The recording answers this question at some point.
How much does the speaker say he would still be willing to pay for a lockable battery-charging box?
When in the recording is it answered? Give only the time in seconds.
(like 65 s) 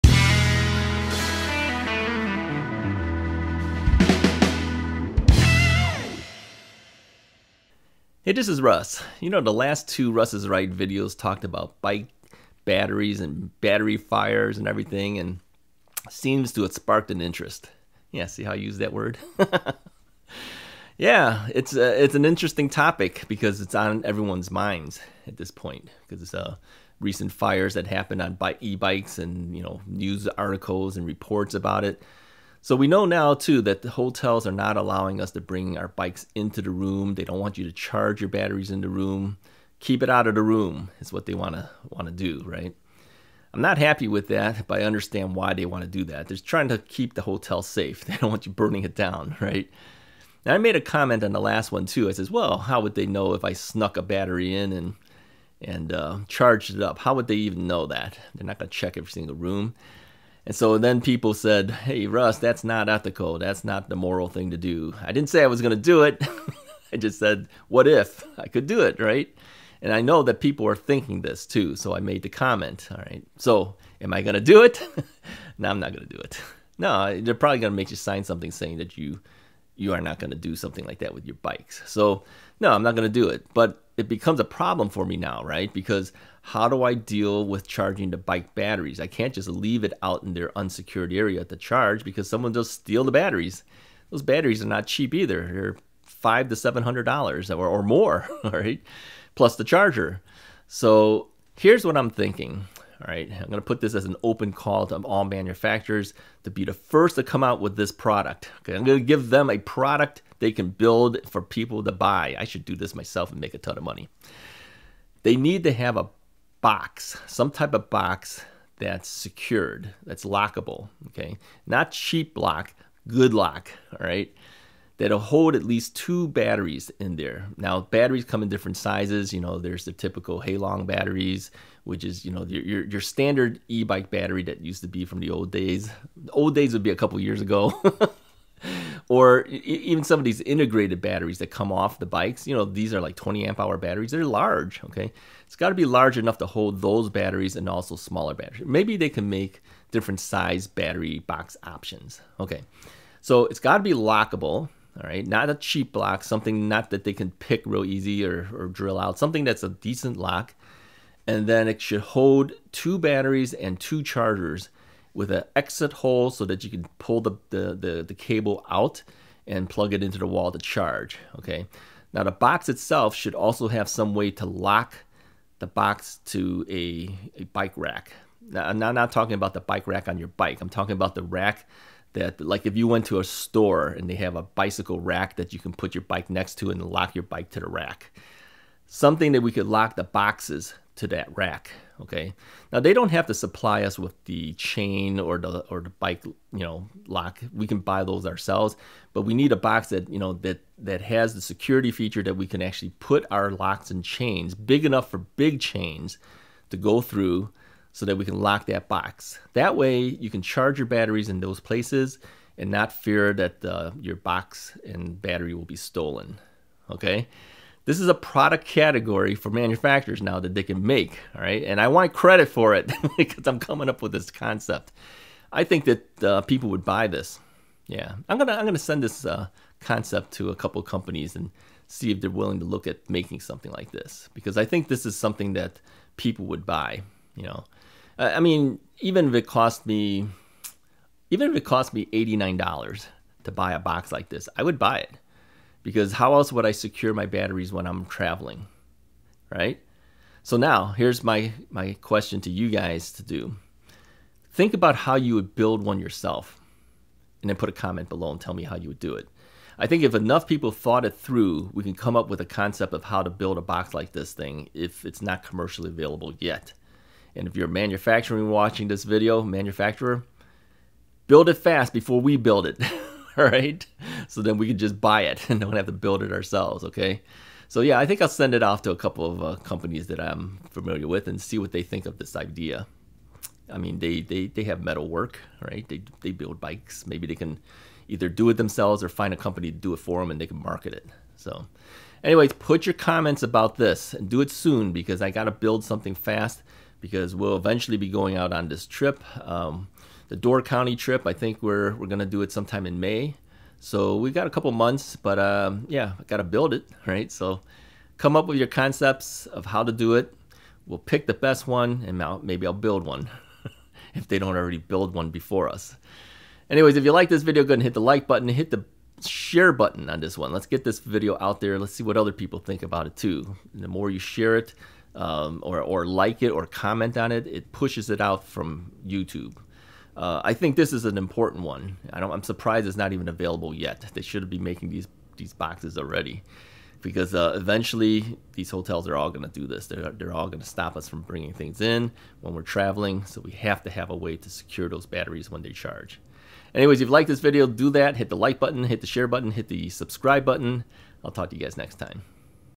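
242 s.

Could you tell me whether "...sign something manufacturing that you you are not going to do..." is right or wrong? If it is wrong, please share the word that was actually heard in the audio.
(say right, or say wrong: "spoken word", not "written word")
wrong: "saying", not "manufacturing".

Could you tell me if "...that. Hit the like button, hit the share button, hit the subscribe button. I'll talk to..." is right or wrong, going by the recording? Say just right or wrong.
right.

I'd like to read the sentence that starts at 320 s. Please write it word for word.
Let's get this video out there.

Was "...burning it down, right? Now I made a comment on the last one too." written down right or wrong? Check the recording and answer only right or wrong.
right.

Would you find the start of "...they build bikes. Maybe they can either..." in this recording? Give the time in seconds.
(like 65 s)
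286 s.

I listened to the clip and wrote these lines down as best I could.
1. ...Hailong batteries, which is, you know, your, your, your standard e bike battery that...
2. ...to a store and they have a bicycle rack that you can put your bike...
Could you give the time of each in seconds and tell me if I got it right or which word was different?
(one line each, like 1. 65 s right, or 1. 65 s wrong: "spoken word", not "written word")
1. 130 s right
2. 183 s right.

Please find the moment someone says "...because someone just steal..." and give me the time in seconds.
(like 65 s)
92 s.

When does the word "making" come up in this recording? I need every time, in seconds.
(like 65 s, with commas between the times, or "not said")
233 s, 334 s.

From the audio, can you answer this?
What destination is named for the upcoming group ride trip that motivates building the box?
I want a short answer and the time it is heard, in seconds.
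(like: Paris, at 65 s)
Door County, at 300 s.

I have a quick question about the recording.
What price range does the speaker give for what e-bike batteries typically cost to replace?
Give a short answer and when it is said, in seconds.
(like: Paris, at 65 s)
$500 to $700, at 96 s.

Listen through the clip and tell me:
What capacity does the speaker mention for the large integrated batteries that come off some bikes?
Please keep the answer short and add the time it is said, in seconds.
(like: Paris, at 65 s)
20 amp hour, at 143 s.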